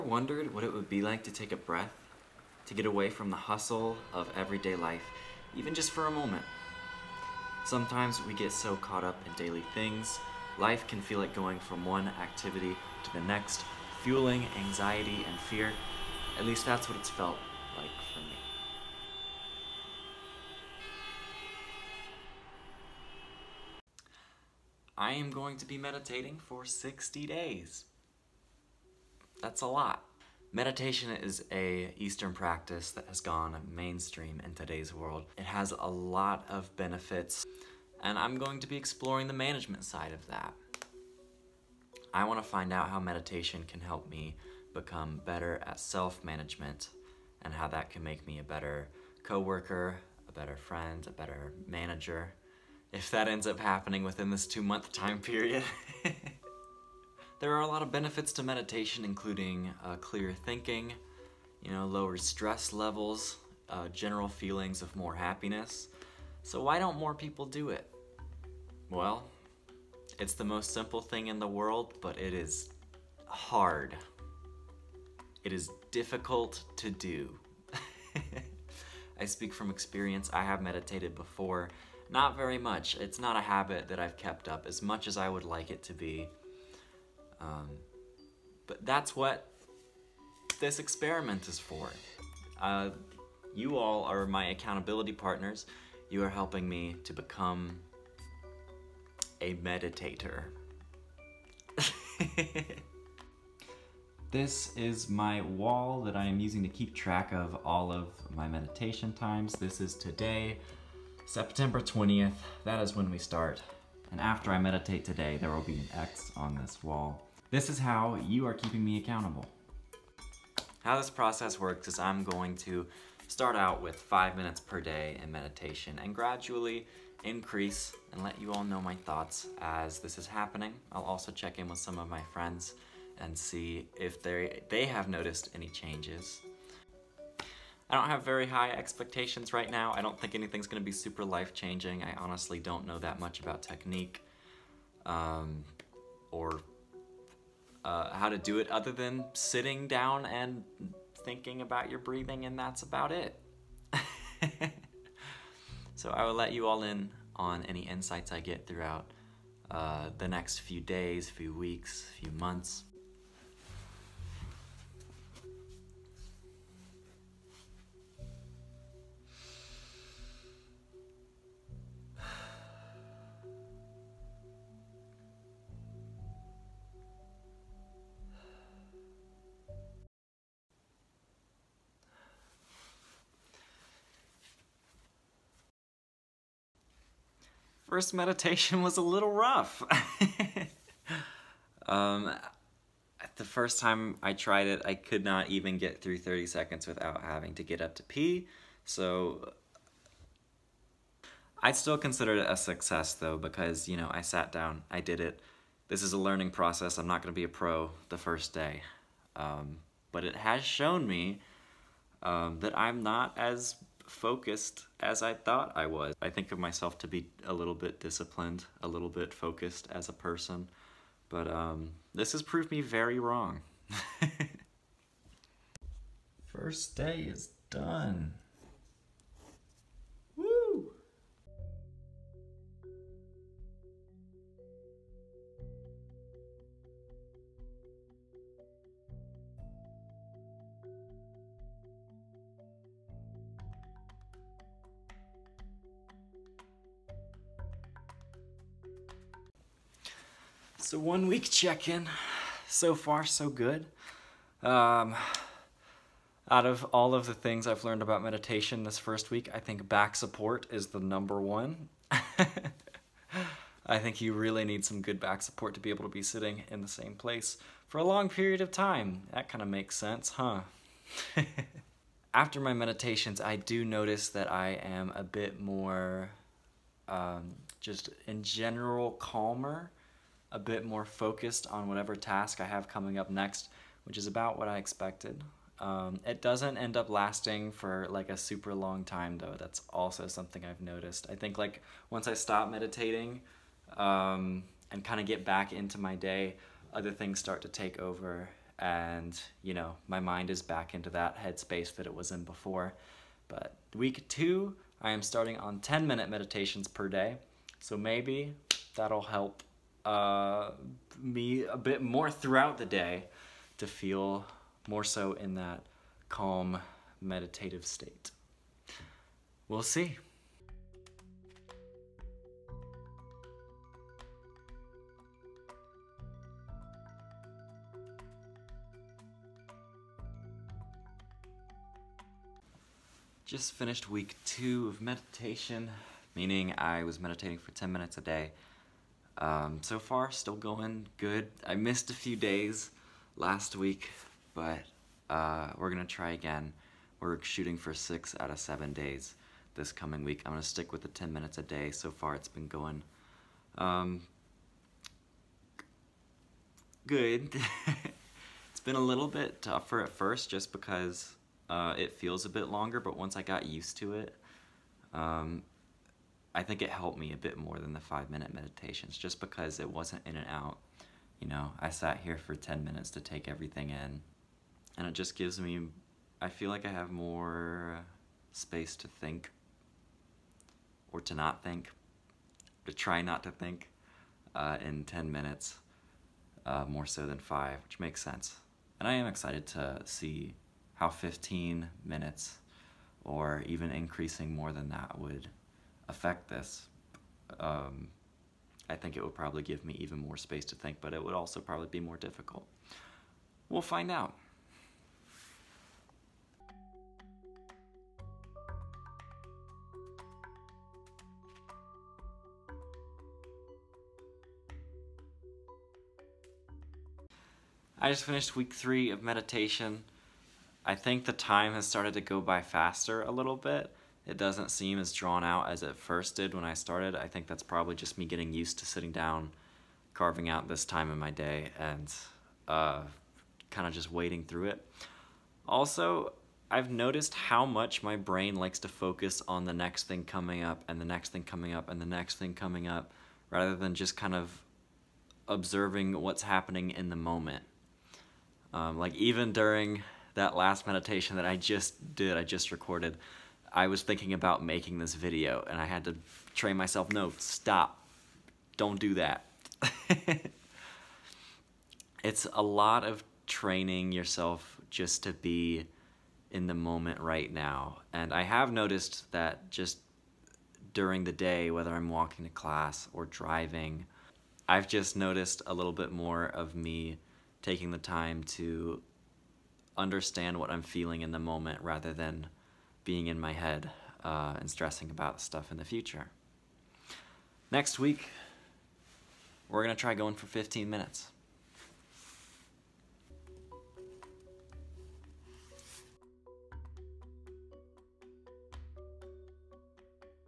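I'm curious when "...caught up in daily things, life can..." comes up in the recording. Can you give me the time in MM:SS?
00:08.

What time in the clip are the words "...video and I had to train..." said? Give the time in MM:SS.
07:35.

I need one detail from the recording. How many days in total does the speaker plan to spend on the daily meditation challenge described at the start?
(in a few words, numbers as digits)
60.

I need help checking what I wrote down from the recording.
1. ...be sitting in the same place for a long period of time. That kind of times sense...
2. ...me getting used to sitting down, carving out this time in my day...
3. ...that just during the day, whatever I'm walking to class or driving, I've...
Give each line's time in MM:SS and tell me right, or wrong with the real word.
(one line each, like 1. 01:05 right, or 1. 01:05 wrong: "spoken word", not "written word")
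1. 04:26 wrong: "makes", not "times"
2. 07:08 right
3. 07:49 wrong: "whether", not "whatever".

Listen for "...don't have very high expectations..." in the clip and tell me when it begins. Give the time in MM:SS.
02:17.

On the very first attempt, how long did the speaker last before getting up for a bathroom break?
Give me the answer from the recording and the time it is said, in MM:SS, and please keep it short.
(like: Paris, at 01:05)
30 seconds, at 03:16.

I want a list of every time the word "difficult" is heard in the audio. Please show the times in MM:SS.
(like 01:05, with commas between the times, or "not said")
01:15, 06:42.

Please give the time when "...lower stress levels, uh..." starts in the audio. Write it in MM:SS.
01:01.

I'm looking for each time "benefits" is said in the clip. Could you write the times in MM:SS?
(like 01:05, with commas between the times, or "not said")
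00:36, 00:57.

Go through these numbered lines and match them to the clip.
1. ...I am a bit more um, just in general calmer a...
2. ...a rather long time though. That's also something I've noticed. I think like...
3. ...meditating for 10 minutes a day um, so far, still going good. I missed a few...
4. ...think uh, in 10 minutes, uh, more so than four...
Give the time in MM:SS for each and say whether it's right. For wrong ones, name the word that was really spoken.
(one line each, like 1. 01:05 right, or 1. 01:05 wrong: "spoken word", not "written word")
1. 04:34 right
2. 04:48 wrong: "super", not "rather"
3. 05:37 right
4. 06:23 wrong: "five", not "four".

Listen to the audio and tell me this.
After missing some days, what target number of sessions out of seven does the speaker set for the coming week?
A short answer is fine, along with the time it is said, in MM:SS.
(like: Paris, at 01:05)
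6, at 05:47.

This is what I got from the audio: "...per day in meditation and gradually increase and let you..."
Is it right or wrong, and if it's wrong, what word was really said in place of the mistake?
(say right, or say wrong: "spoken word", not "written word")
right.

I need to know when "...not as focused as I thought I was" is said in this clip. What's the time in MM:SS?
03:33.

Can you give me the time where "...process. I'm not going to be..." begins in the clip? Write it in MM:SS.
03:26.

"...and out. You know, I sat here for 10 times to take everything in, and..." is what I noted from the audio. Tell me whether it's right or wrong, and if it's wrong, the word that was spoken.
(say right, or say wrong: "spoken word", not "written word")
wrong: "minutes", not "times".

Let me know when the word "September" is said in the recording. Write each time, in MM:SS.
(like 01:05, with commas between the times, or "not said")
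01:51.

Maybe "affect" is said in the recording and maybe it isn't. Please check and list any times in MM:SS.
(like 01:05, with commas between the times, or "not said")
06:36.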